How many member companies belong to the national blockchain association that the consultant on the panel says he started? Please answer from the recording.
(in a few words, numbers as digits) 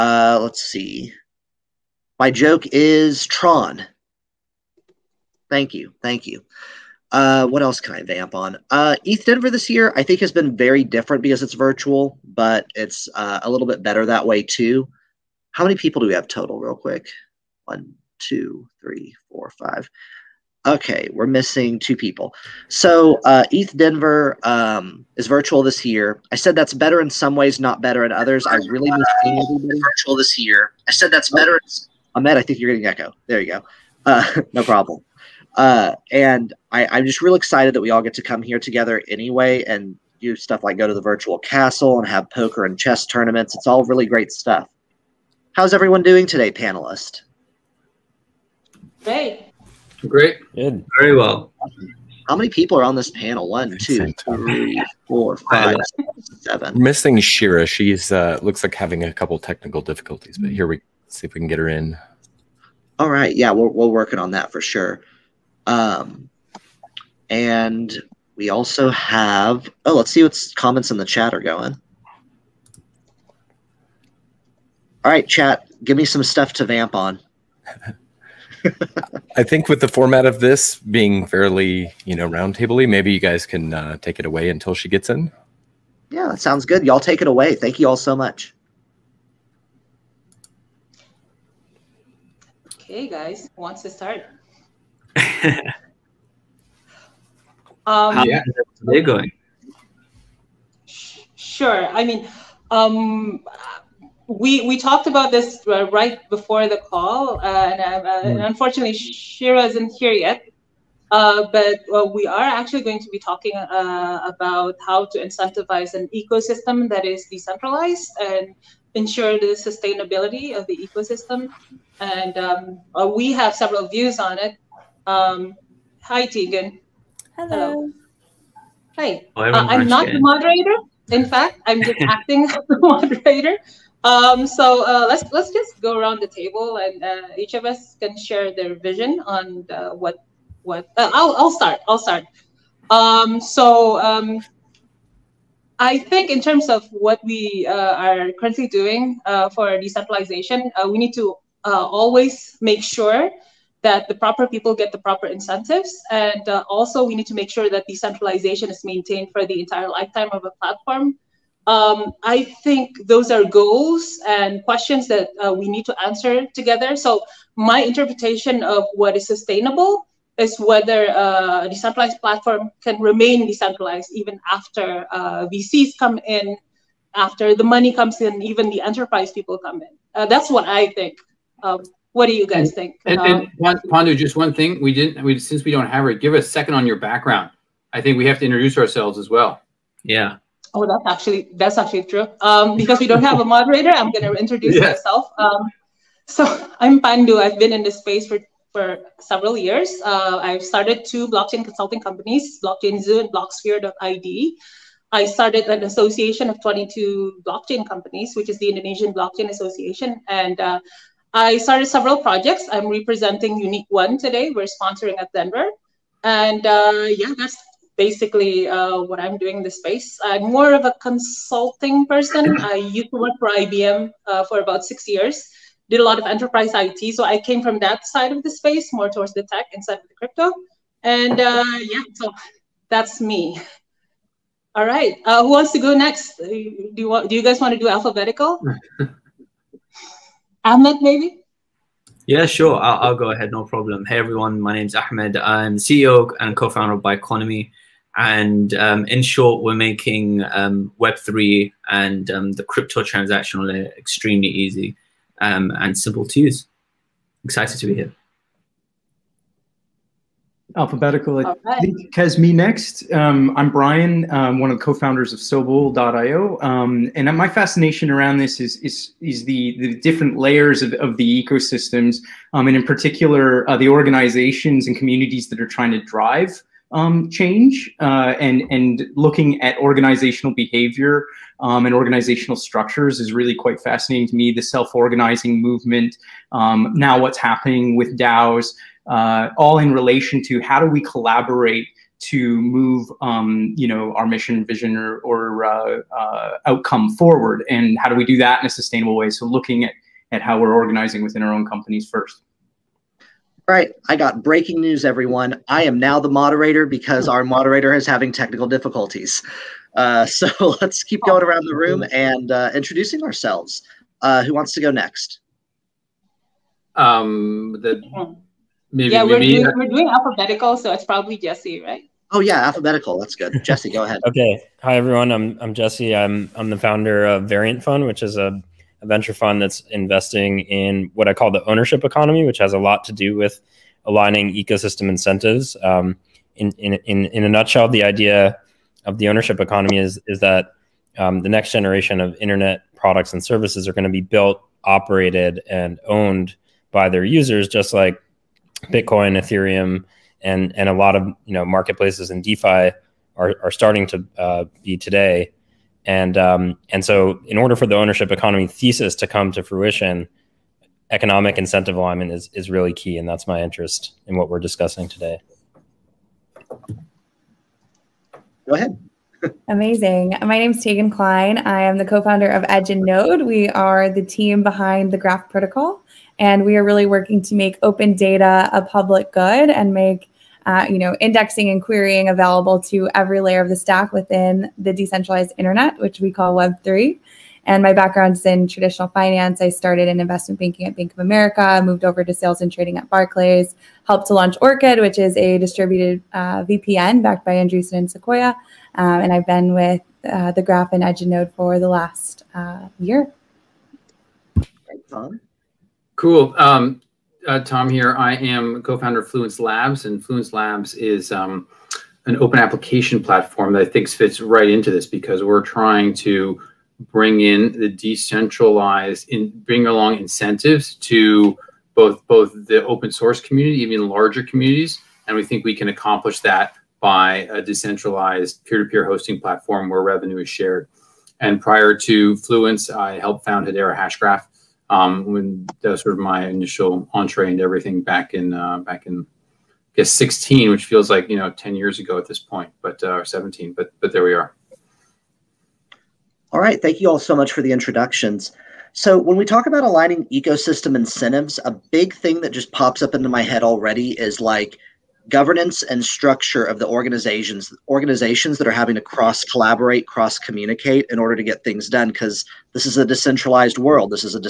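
22.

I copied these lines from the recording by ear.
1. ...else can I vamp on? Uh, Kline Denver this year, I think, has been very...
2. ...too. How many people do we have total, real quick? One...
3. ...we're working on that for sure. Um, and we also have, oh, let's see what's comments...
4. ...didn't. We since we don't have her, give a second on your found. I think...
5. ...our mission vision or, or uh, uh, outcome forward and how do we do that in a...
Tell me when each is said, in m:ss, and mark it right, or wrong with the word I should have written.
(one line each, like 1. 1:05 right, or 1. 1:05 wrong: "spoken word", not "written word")
1. 0:07 wrong: "ETH", not "Kline"
2. 0:14 right
3. 1:03 right
4. 3:04 wrong: "background", not "found"
5. 4:54 right.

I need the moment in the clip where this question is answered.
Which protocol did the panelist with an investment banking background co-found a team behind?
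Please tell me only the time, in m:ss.
6:15.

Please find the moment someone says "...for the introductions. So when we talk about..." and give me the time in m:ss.
7:27.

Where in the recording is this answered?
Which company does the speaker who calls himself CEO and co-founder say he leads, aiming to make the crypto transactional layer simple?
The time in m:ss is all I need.
4:07.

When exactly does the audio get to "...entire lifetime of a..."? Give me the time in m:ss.
2:39.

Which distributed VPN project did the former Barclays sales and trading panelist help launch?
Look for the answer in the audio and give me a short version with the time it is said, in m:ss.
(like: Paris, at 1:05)
Orchid, at 6:34.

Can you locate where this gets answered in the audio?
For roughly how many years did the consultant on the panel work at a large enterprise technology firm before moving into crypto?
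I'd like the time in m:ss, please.
3:44.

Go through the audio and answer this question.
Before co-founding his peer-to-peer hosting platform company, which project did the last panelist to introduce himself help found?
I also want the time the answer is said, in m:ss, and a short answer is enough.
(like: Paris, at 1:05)
Hedera Hashgraph, at 7:13.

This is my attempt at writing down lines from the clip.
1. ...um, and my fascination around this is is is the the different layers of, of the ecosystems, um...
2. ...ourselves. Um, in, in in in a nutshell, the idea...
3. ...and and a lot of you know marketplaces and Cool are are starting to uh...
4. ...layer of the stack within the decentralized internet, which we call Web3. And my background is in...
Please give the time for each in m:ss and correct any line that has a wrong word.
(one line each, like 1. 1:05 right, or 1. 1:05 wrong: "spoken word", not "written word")
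1. 4:26 right
2. 5:35 wrong: "incentives", not "ourselves"
3. 5:50 wrong: "DeFi", not "Cool"
4. 6:23 right.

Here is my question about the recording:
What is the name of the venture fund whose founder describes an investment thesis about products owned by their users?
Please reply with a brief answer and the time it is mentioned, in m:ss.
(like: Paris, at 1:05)
Variant Fund, at 5:27.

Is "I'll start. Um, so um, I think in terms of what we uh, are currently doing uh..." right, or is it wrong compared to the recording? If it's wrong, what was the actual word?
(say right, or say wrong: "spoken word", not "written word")
right.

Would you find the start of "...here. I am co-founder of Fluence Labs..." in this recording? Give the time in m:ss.
6:47.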